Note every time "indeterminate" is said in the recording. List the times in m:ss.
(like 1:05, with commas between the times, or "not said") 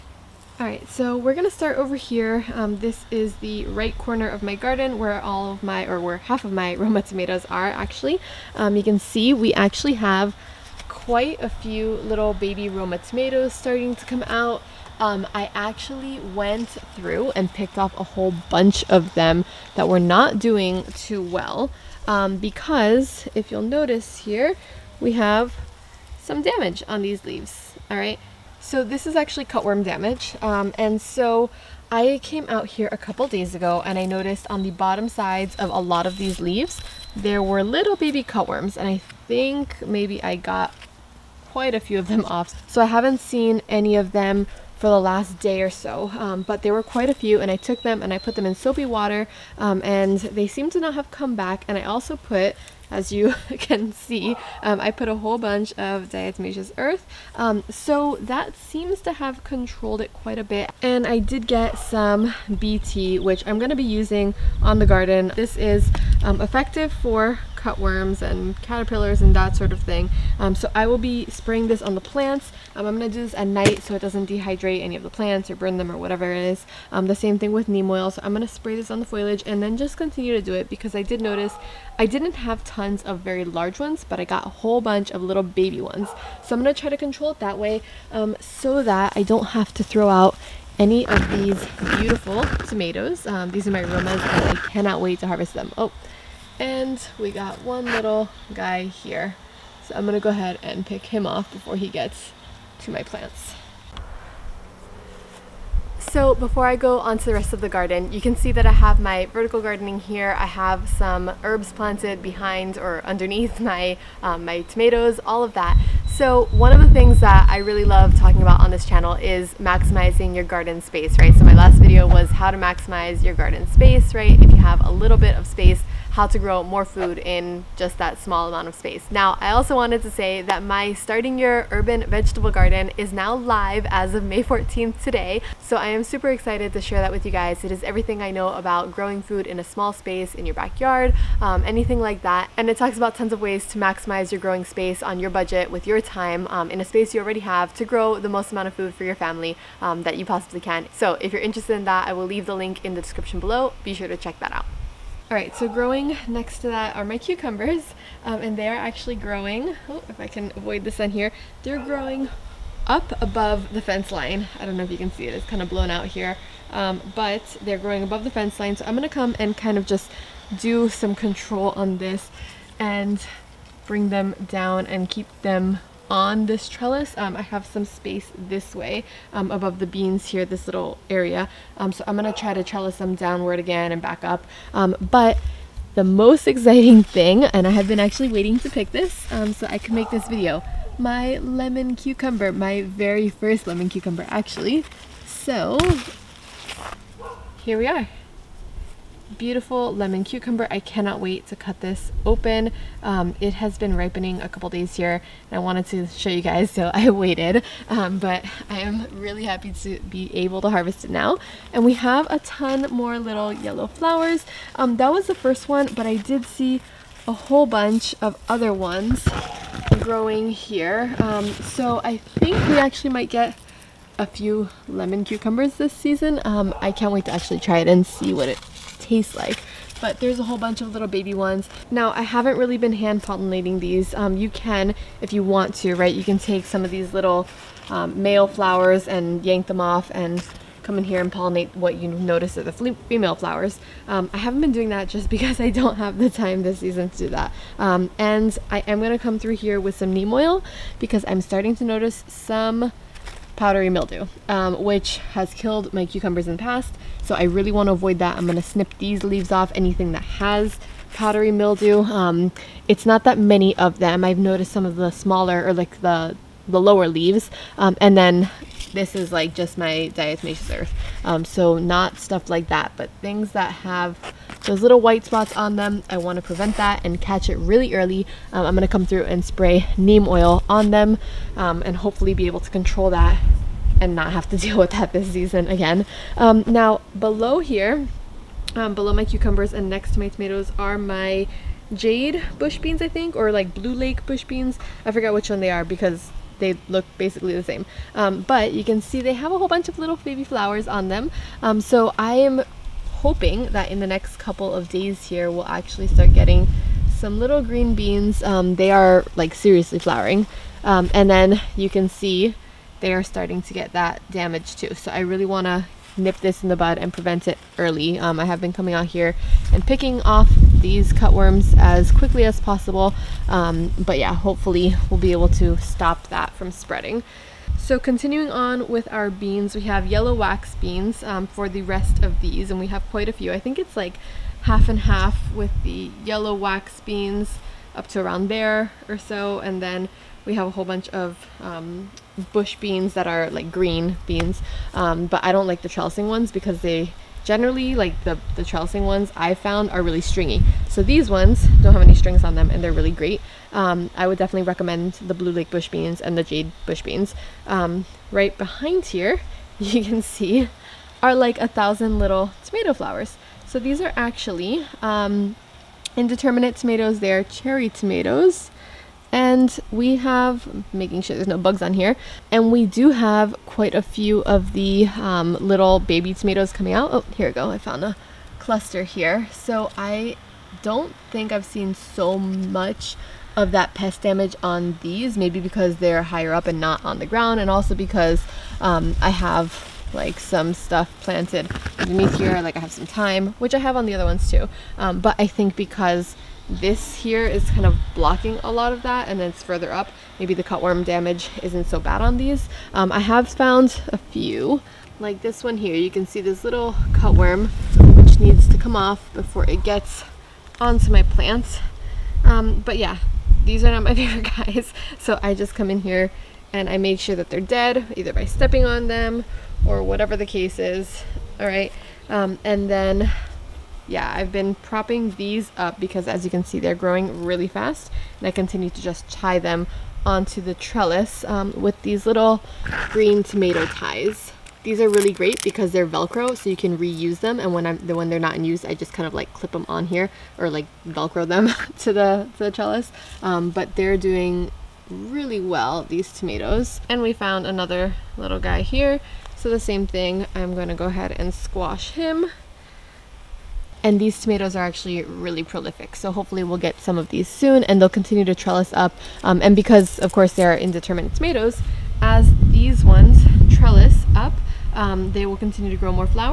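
6:06, 7:40.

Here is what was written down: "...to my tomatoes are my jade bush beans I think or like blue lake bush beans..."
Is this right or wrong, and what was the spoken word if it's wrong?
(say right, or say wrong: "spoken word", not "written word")
right.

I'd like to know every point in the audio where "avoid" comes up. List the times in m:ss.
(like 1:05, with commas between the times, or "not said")
2:40, 4:17.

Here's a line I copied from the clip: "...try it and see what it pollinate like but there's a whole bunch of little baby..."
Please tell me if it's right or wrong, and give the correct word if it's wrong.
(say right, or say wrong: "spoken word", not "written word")
wrong: "taste", not "pollinate".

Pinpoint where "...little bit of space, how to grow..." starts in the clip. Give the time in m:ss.
2:04.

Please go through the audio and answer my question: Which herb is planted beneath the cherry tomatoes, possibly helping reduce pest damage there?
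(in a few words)
Thyme.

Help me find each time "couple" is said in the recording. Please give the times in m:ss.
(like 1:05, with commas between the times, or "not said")
0:32, 3:24, 5:04.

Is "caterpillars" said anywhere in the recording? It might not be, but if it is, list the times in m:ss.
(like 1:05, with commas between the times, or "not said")
1:08.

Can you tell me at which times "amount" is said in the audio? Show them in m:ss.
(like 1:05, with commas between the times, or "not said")
2:08, 2:28.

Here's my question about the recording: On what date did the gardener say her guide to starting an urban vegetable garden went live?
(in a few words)
May 14th.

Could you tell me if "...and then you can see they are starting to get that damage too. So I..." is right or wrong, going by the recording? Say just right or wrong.
right.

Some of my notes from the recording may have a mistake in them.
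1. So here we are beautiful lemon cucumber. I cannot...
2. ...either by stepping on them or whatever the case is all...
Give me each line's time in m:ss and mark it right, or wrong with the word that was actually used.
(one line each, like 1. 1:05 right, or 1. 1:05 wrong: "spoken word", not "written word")
1. 3:15 right
2. 6:58 right.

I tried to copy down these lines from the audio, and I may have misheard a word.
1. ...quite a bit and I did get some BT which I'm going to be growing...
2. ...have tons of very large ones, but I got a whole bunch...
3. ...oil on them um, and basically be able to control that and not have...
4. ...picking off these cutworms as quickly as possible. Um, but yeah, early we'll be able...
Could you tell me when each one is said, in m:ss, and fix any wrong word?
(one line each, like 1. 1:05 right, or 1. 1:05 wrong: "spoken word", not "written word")
1. 1:00 wrong: "using", not "growing"
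2. 1:22 right
3. 4:40 wrong: "hopefully", not "basically"
4. 5:19 wrong: "hopefully", not "early".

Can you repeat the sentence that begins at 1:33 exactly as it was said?
Um, these are my Romas and I cannot wait to harvest them.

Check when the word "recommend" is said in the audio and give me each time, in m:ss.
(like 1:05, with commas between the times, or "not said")
5:54.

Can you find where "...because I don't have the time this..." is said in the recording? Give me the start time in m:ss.
4:05.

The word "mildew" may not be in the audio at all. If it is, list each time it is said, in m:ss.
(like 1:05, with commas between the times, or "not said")
4:13, 4:21.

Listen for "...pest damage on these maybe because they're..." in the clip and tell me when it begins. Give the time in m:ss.
6:23.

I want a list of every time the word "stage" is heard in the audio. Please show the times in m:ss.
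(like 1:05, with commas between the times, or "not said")
not said.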